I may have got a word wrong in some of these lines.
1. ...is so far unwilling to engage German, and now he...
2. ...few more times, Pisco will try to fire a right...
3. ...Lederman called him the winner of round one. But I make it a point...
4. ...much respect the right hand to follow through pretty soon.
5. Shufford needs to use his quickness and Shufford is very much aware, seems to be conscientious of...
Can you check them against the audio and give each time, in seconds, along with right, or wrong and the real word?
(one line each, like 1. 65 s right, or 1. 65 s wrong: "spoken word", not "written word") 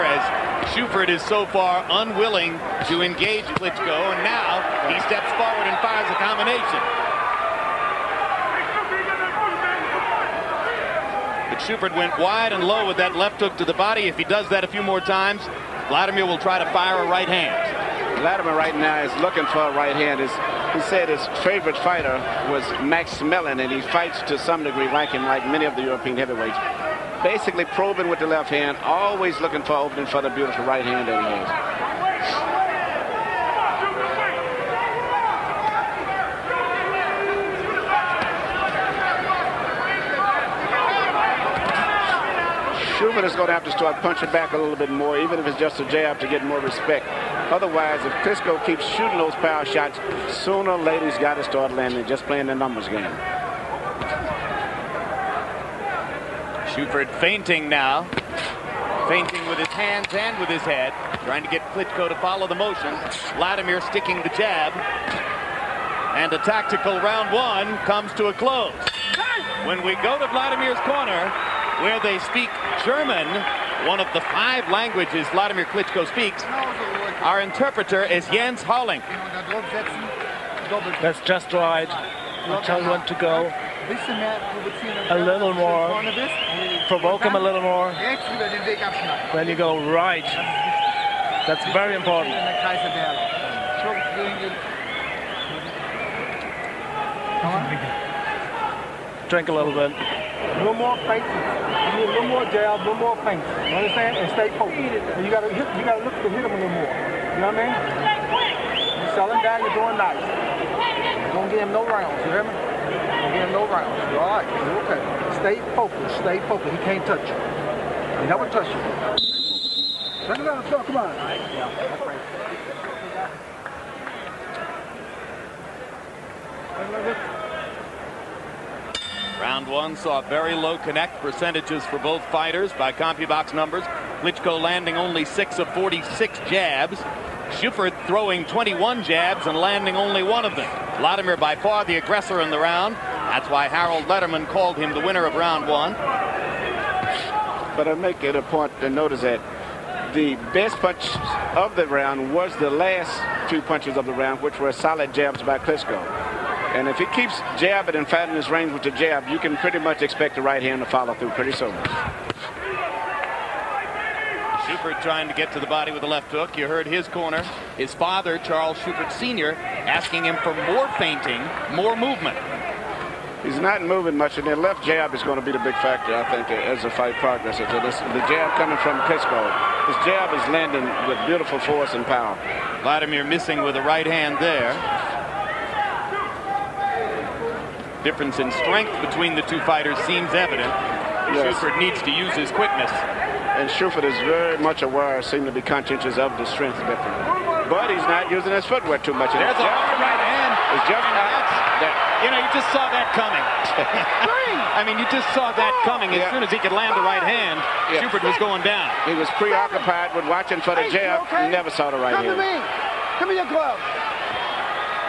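1. 1 s wrong: "Klitschko", not "German"
2. 14 s wrong: "Vladimir", not "Pisco"
3. 144 s right
4. 159 s wrong: "expect", not "respect"
5. 191 s right.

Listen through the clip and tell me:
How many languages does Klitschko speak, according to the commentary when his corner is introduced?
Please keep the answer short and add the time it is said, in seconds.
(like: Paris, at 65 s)
5, at 74 s.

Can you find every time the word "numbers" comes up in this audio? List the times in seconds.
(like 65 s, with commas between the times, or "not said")
52 s, 133 s.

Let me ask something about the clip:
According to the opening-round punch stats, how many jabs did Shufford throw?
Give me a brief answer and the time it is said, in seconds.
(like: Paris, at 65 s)
21, at 138 s.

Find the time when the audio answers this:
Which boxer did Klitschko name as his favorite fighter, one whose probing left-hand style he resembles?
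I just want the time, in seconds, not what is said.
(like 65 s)
22 s.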